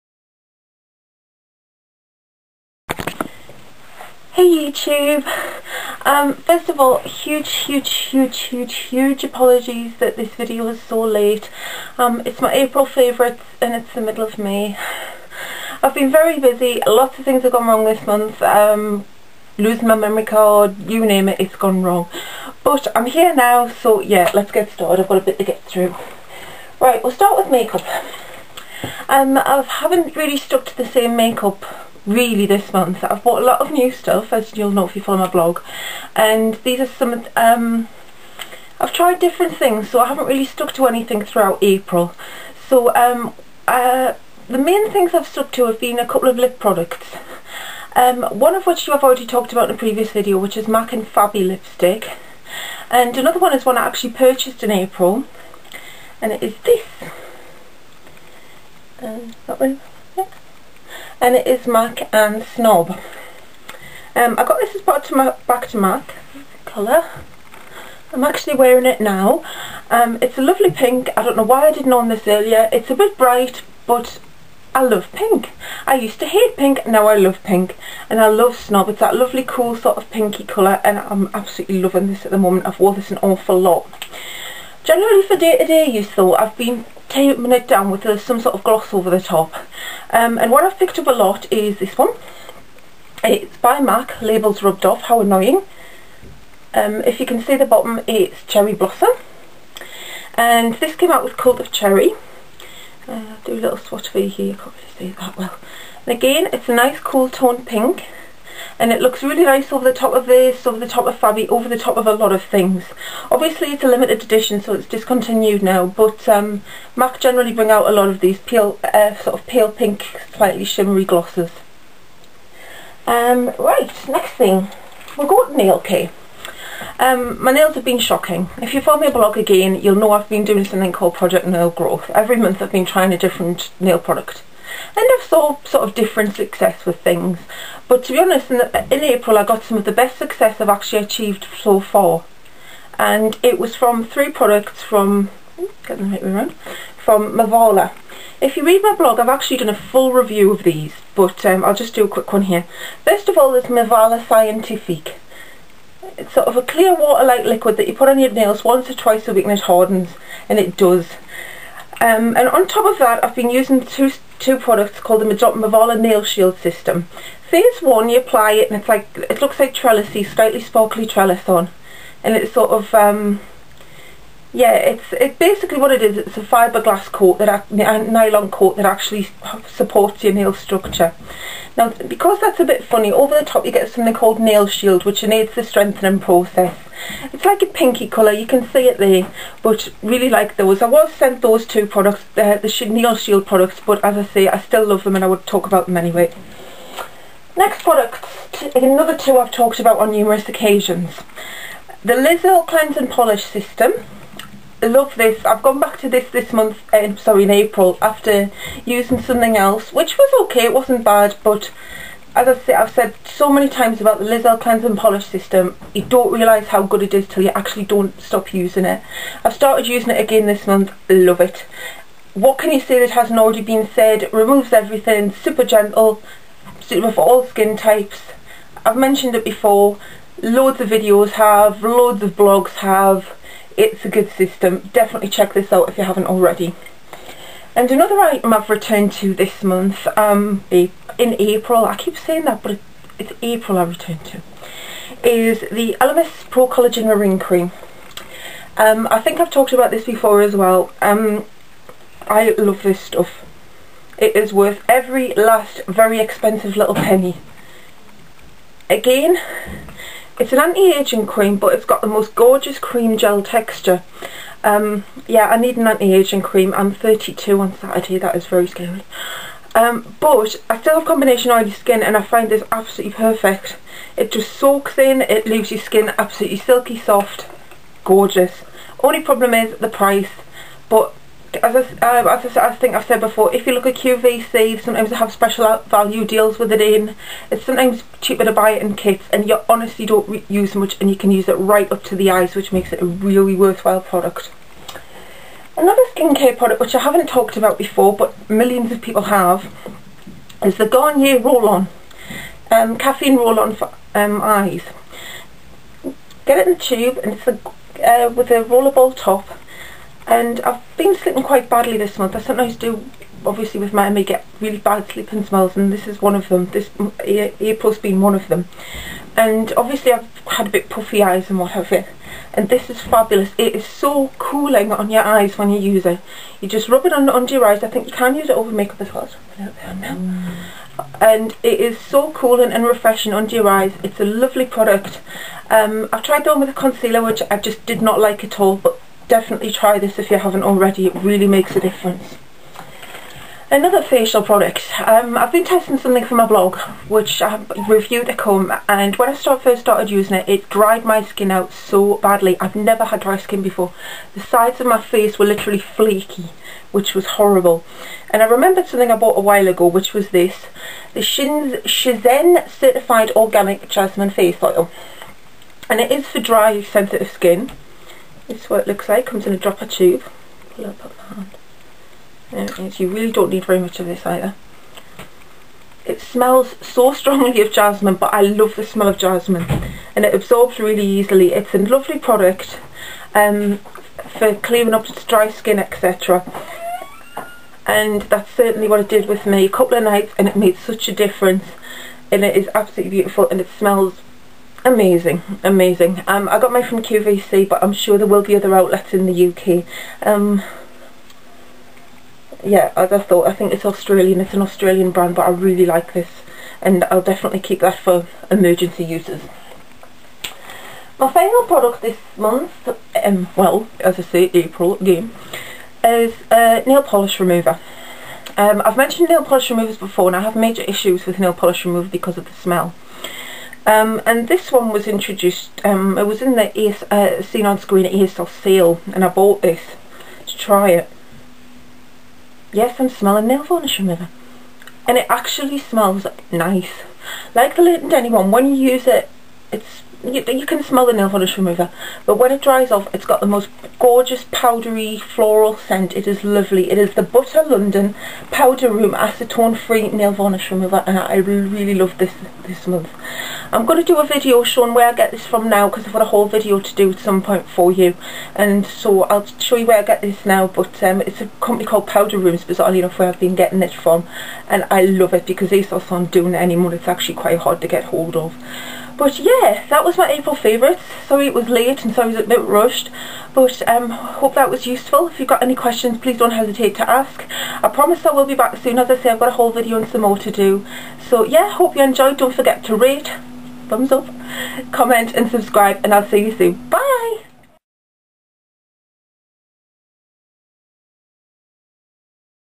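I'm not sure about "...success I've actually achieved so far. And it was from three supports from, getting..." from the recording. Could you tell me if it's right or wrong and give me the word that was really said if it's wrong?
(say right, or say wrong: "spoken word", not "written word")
wrong: "products", not "supports".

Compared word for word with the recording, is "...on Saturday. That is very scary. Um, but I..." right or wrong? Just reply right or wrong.
right.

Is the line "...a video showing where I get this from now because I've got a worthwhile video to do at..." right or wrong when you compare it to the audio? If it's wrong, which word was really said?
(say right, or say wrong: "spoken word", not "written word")
wrong: "whole", not "worthwhile".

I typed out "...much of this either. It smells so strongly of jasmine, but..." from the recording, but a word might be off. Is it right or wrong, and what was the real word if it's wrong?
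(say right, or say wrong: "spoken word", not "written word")
right.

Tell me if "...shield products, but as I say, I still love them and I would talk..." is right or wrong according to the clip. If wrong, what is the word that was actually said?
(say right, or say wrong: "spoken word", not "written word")
right.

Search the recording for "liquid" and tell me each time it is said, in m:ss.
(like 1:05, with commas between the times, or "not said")
2:37.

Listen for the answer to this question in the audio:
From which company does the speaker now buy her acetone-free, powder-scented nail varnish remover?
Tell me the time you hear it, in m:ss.
7:42.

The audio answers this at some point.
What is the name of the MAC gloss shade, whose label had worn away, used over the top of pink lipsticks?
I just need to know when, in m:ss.
1:38.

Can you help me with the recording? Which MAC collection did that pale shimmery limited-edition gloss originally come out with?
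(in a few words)
Cult of Cherry.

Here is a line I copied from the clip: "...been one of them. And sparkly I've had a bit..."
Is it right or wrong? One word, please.
wrong.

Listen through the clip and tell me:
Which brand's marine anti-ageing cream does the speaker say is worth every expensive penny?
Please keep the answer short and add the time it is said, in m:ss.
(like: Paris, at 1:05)
Elemis, at 4:05.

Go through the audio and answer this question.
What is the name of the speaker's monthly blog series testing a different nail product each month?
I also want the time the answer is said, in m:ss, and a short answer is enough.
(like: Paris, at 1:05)
Project Nail Growth, at 2:11.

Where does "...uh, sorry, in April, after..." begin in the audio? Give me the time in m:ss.
3:26.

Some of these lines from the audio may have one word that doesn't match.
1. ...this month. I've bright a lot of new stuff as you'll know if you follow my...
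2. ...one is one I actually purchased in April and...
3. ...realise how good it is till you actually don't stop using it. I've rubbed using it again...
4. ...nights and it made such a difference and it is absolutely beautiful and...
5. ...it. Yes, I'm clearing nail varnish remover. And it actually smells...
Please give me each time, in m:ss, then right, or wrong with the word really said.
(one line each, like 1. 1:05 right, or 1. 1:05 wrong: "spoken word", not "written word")
1. 0:32 wrong: "bought", not "bright"
2. 0:53 right
3. 3:36 wrong: "started", not "rubbed"
4. 6:30 right
5. 7:10 wrong: "smelling", not "clearing".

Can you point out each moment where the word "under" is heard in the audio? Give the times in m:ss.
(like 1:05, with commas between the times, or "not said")
5:27, 5:33.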